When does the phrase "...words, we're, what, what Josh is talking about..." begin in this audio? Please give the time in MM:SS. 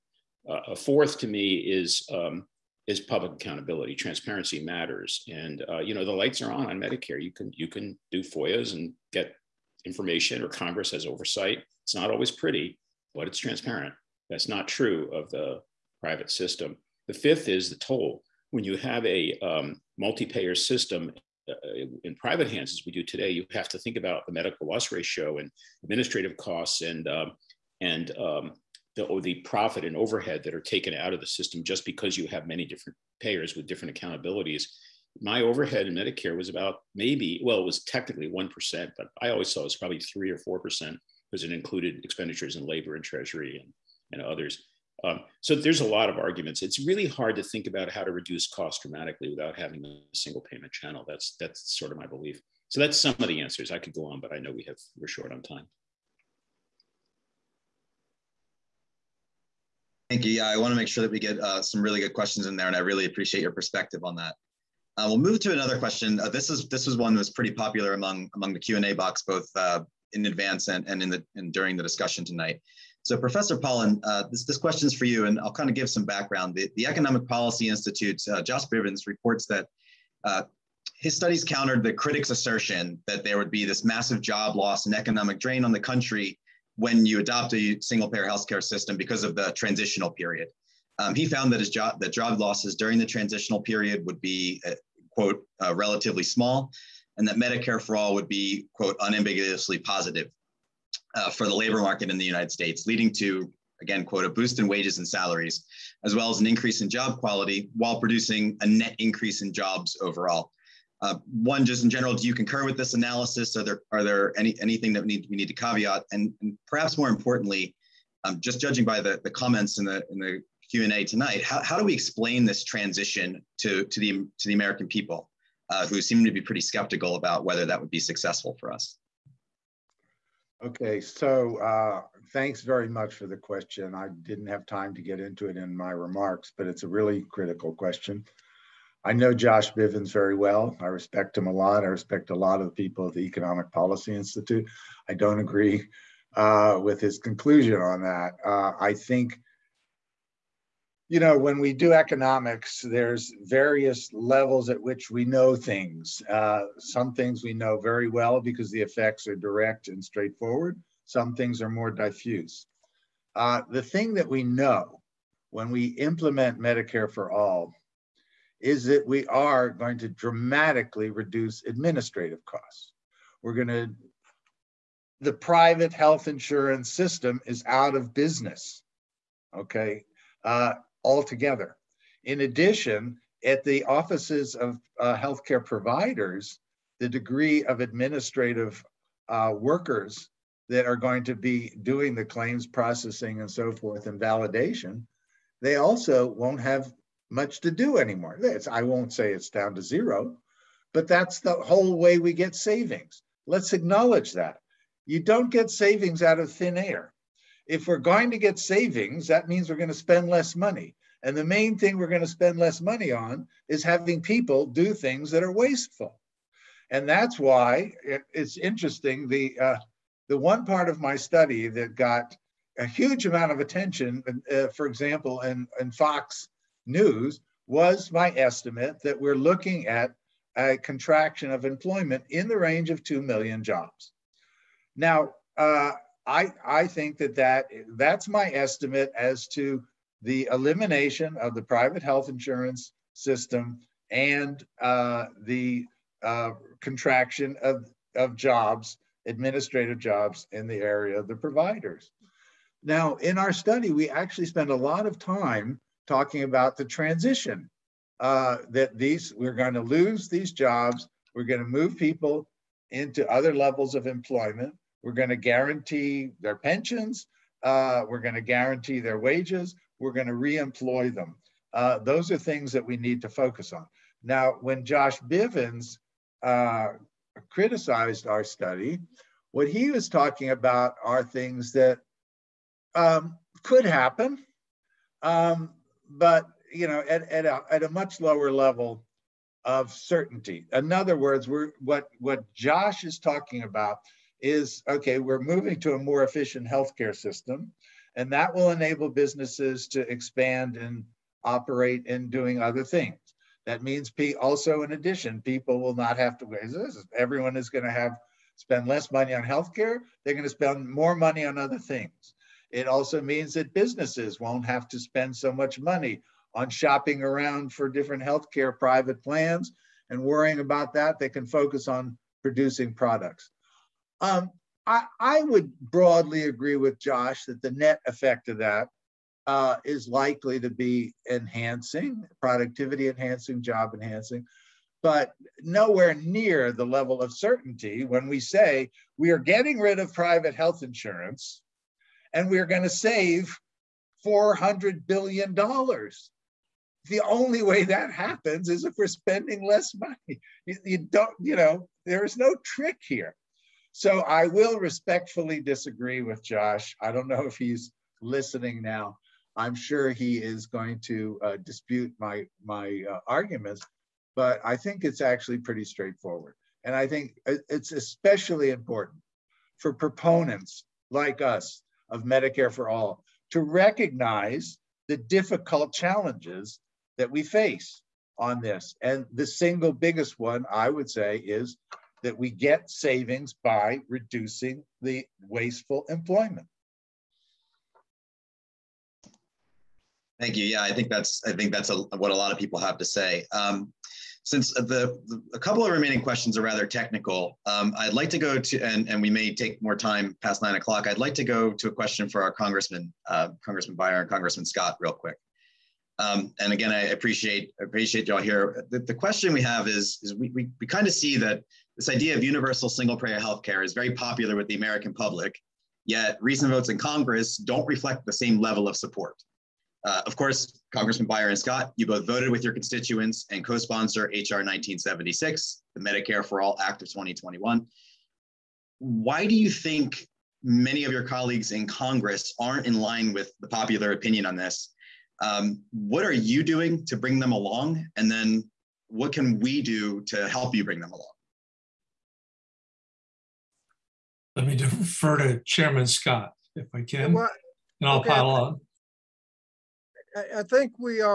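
04:51.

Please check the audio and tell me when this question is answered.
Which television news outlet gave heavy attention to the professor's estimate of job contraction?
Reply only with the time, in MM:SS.
03:45.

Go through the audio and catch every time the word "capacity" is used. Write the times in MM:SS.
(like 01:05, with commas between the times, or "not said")
not said.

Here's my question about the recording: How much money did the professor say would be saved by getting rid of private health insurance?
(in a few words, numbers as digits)
$400 billion.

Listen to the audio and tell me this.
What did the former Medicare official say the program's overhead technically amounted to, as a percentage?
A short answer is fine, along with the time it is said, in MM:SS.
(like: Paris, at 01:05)
1%, at 00:38.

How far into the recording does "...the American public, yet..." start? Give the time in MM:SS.
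06:54.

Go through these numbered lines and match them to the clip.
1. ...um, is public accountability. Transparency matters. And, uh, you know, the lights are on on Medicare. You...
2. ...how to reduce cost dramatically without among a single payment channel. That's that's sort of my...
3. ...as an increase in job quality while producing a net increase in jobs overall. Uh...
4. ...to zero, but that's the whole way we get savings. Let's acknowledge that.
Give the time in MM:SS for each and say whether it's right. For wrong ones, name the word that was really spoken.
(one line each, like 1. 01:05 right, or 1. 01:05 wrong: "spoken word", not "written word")
1. 00:02 right
2. 00:47 wrong: "having", not "among"
3. 01:46 right
4. 03:19 right.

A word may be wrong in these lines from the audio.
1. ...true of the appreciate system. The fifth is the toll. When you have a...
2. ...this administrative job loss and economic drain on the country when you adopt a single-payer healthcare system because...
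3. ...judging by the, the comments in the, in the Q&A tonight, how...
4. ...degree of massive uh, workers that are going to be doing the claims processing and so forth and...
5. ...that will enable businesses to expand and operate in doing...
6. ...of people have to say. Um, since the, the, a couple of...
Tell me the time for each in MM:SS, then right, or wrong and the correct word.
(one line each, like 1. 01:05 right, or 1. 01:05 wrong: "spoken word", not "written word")
1. 00:14 wrong: "private", not "appreciate"
2. 01:23 wrong: "massive", not "administrative"
3. 01:58 right
4. 03:07 wrong: "administrative", not "massive"
5. 04:58 right
6. 06:32 right.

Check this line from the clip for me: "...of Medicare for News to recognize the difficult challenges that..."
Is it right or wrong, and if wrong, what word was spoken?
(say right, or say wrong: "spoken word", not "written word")
wrong: "All", not "News".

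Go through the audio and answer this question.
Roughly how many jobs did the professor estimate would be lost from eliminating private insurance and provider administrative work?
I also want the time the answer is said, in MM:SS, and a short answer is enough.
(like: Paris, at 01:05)
2 million, at 03:53.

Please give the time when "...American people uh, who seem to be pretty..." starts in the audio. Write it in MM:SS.
02:04.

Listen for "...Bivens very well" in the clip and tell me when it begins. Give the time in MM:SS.
02:19.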